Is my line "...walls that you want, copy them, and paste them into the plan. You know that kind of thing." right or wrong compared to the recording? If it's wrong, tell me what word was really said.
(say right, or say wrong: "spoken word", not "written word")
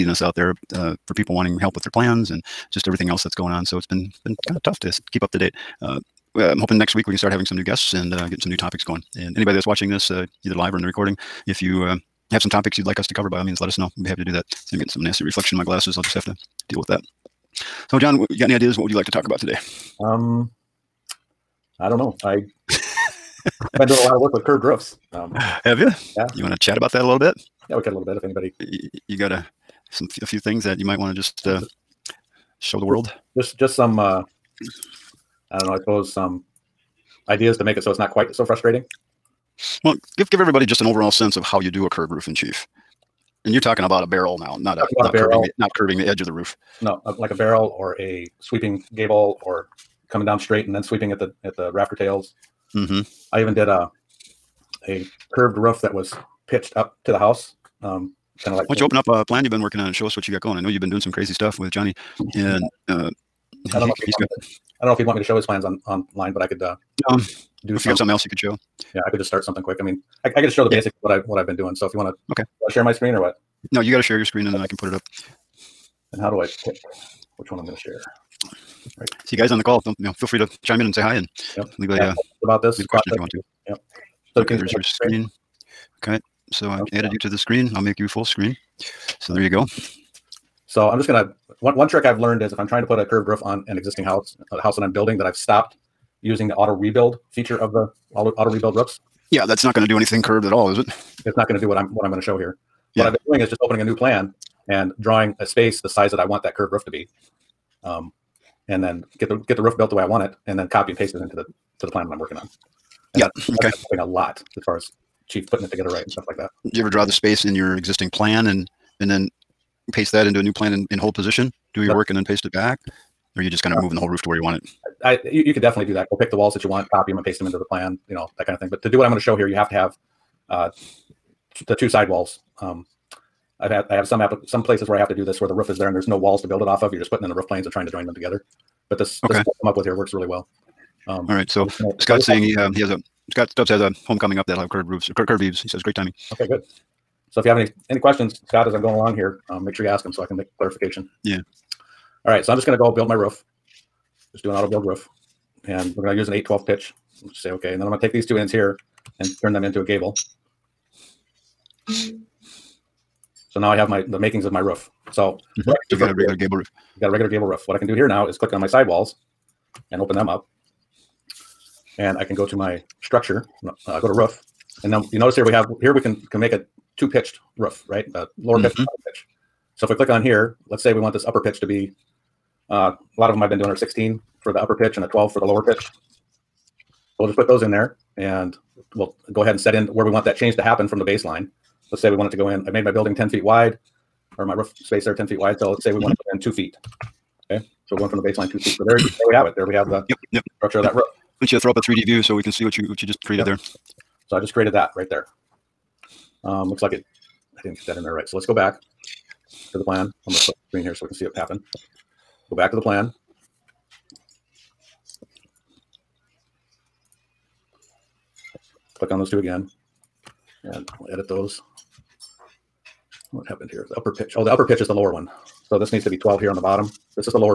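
right.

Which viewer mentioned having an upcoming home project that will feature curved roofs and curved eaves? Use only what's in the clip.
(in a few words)
Scott Stubbs.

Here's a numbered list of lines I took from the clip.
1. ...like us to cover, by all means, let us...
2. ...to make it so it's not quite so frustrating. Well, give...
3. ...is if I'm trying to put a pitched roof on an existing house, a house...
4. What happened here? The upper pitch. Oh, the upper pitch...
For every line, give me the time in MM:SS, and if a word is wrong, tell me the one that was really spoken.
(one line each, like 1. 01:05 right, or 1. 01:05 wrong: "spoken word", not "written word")
1. 00:12 right
2. 00:37 right
3. 01:32 wrong: "curved", not "pitched"
4. 03:43 right.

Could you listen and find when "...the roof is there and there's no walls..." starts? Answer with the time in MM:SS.
02:15.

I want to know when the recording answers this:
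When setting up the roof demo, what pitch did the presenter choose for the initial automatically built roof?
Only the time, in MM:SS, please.
02:36.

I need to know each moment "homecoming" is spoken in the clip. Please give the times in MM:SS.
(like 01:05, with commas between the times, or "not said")
02:24.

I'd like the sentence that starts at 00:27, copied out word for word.
Yeah, we could a little bit if anybody.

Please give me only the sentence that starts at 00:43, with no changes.
And you're talking about a barrel now, not a, not, a barrel.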